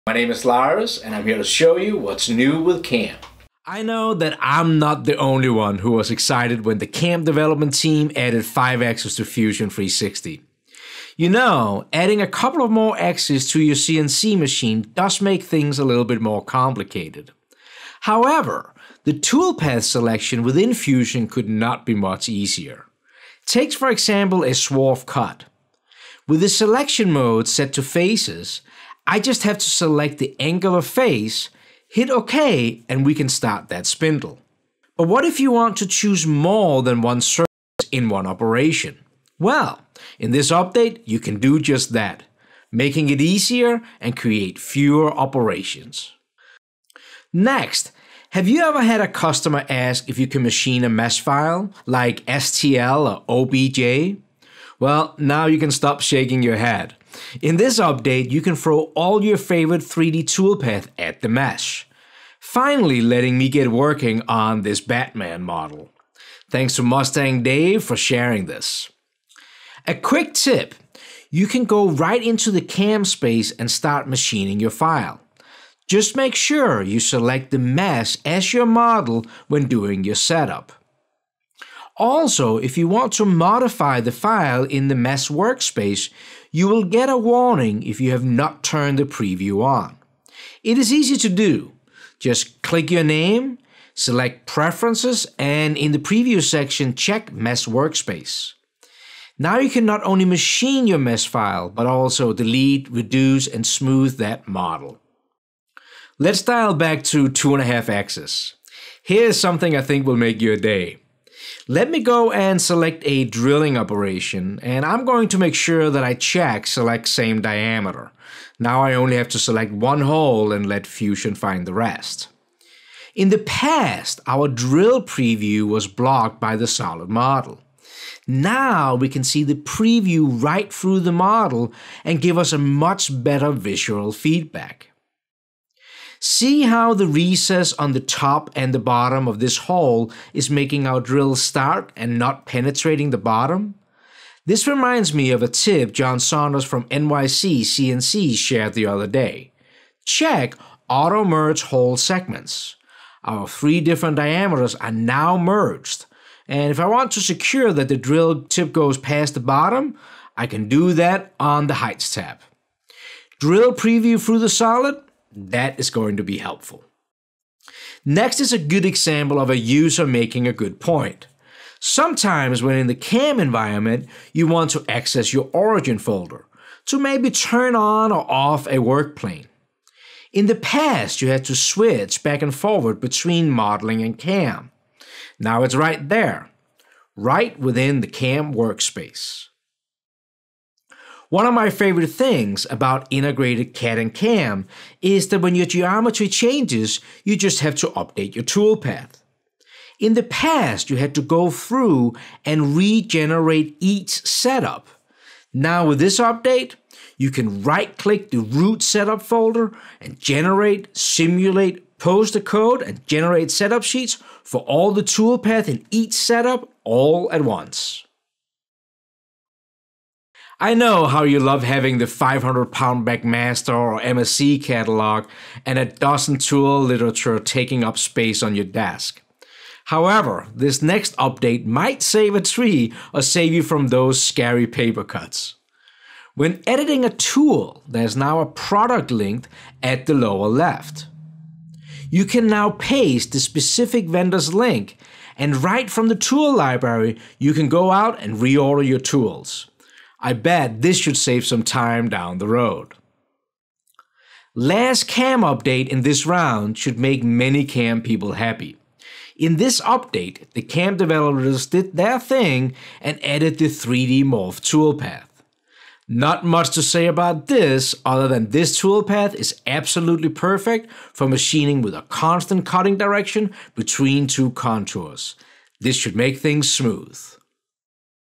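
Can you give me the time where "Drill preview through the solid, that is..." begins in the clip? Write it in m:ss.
2:43.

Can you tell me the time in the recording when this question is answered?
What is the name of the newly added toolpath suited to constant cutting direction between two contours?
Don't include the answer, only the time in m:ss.
4:23.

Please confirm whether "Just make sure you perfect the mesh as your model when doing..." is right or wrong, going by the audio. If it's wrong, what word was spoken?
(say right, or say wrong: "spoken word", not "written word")
wrong: "select", not "perfect".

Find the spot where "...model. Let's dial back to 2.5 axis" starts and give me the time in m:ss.
1:44.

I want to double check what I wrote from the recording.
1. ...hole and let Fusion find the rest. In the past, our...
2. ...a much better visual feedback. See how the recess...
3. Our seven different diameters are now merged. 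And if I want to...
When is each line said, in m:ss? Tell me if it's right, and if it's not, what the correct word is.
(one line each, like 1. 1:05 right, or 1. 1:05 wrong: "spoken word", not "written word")
1. 2:00 right
2. 2:12 right
3. 2:33 wrong: "three", not "seven".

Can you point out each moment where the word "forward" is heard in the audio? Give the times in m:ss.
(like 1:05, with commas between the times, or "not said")
3:02.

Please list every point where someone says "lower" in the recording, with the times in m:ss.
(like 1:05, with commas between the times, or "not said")
4:00.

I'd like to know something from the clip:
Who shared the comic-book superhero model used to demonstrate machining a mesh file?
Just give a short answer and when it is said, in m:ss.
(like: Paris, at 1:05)
Mustang Dave, at 1:06.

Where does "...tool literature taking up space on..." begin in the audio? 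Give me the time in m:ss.
3:46.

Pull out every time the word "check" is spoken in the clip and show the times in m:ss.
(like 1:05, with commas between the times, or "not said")
1:36, 1:56, 2:30.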